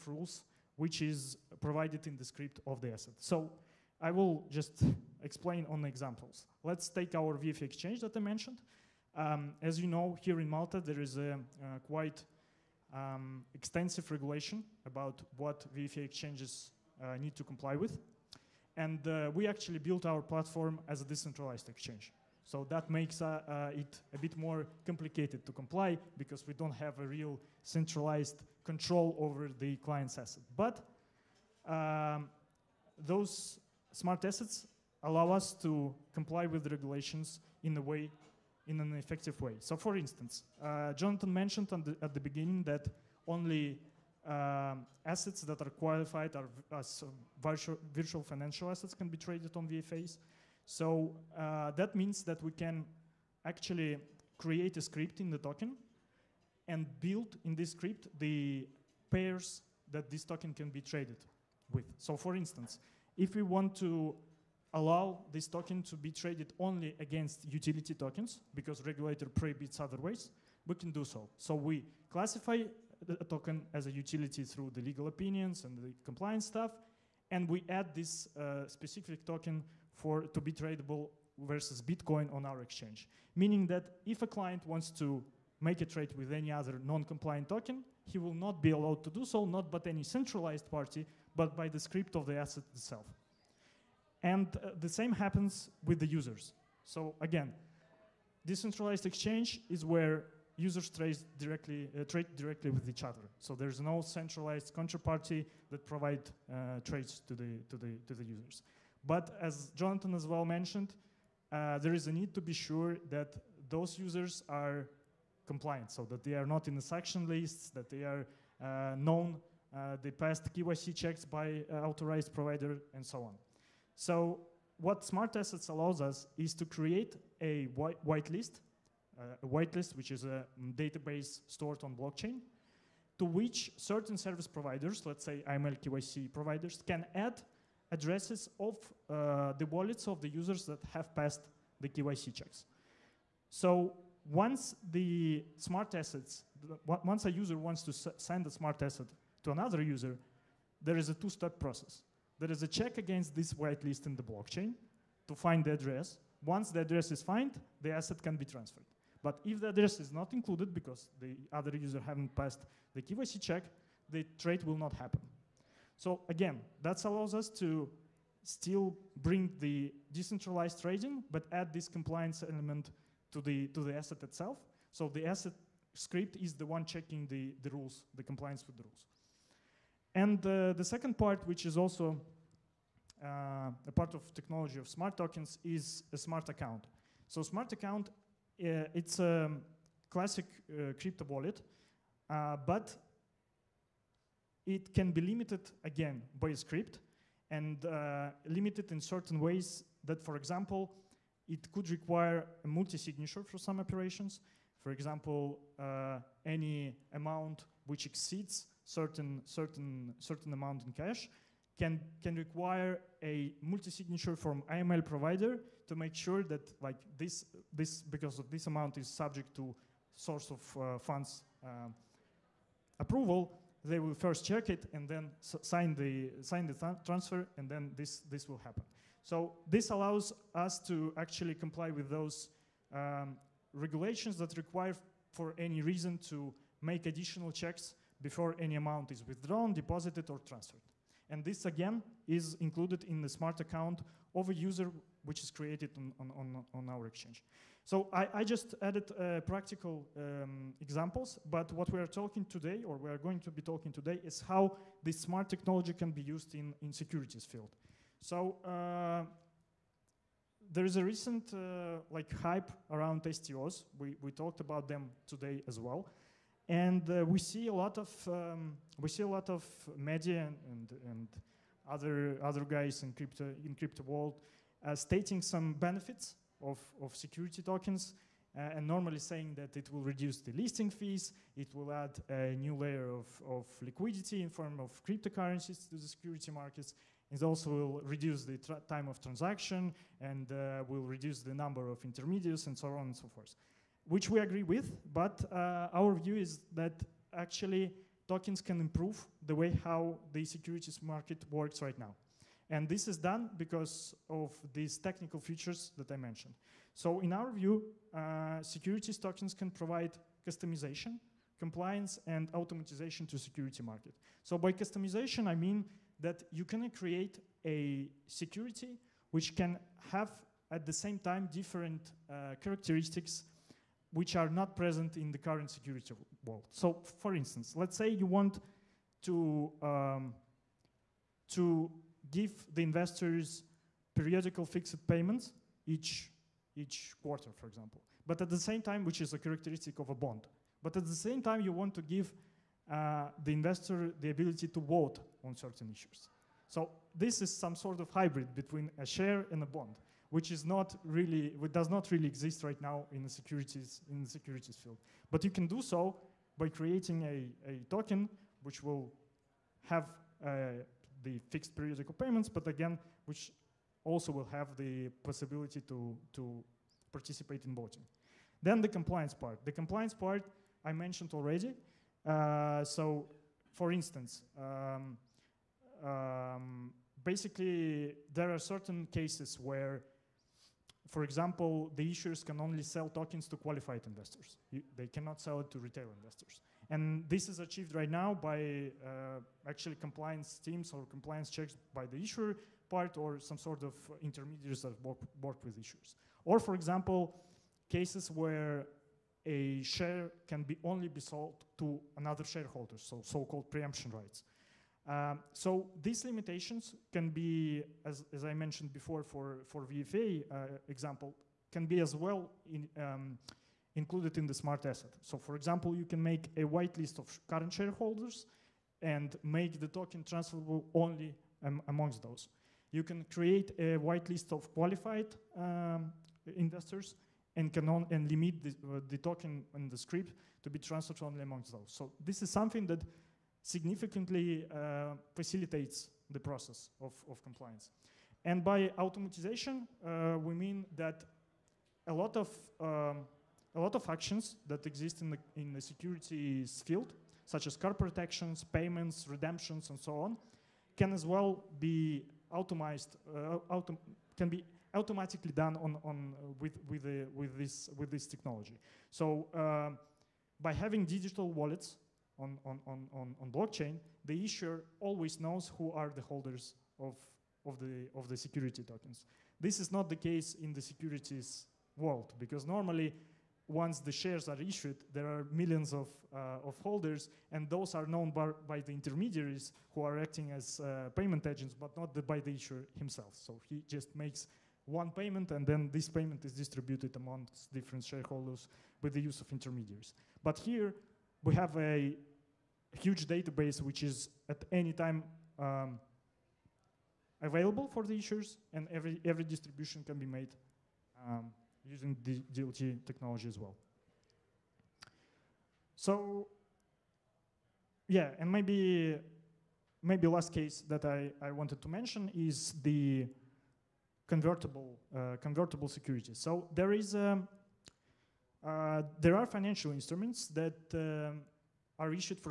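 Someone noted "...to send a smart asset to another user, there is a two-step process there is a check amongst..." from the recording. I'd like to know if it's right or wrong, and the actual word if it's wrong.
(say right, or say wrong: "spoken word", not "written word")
wrong: "against", not "amongst".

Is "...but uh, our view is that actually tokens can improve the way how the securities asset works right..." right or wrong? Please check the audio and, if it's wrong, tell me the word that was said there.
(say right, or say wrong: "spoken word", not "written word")
wrong: "market", not "asset".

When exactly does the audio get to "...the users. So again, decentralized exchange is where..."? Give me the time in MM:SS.
01:35.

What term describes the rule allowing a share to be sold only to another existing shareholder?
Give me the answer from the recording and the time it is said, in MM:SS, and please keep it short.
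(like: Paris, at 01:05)
preemption rights, at 06:43.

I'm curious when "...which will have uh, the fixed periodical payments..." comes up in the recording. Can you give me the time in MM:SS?
05:58.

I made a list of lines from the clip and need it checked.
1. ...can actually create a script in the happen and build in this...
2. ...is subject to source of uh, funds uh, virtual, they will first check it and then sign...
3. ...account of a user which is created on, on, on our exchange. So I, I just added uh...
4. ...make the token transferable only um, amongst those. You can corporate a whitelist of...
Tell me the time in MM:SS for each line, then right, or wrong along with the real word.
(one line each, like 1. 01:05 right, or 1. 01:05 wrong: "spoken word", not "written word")
1. 00:52 wrong: "token", not "happen"
2. 03:38 wrong: "approval", not "virtual"
3. 04:03 right
4. 06:59 wrong: "create", not "corporate".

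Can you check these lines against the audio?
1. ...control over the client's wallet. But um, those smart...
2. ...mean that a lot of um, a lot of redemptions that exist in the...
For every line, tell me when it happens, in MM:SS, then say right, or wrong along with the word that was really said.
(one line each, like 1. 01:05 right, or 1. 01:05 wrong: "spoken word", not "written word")
1. 00:28 wrong: "asset", not "wallet"
2. 07:20 wrong: "actions", not "redemptions".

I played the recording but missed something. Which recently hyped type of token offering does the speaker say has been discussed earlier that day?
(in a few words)
STOs.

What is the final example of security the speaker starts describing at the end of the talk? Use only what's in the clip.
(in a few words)
convertible securities.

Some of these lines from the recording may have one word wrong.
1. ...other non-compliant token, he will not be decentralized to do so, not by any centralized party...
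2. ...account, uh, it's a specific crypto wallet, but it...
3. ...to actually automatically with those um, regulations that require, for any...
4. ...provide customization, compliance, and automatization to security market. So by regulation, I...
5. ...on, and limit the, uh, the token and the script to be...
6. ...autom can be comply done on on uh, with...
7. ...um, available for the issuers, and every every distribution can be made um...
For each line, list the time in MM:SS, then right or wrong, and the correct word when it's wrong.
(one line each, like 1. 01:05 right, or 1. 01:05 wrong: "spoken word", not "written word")
1. 01:26 wrong: "allowed", not "decentralized"
2. 03:07 wrong: "classic", not "specific"
3. 03:50 wrong: "comply", not "automatically"
4. 05:09 wrong: "customization", not "regulation"
5. 07:07 right
6. 07:33 wrong: "automatically", not "comply"
7. 08:15 right.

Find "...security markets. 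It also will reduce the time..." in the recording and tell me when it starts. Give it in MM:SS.
04:46.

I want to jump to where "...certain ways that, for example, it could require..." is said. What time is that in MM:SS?
03:19.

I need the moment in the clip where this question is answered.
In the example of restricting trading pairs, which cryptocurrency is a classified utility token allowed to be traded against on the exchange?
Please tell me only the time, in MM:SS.
01:21.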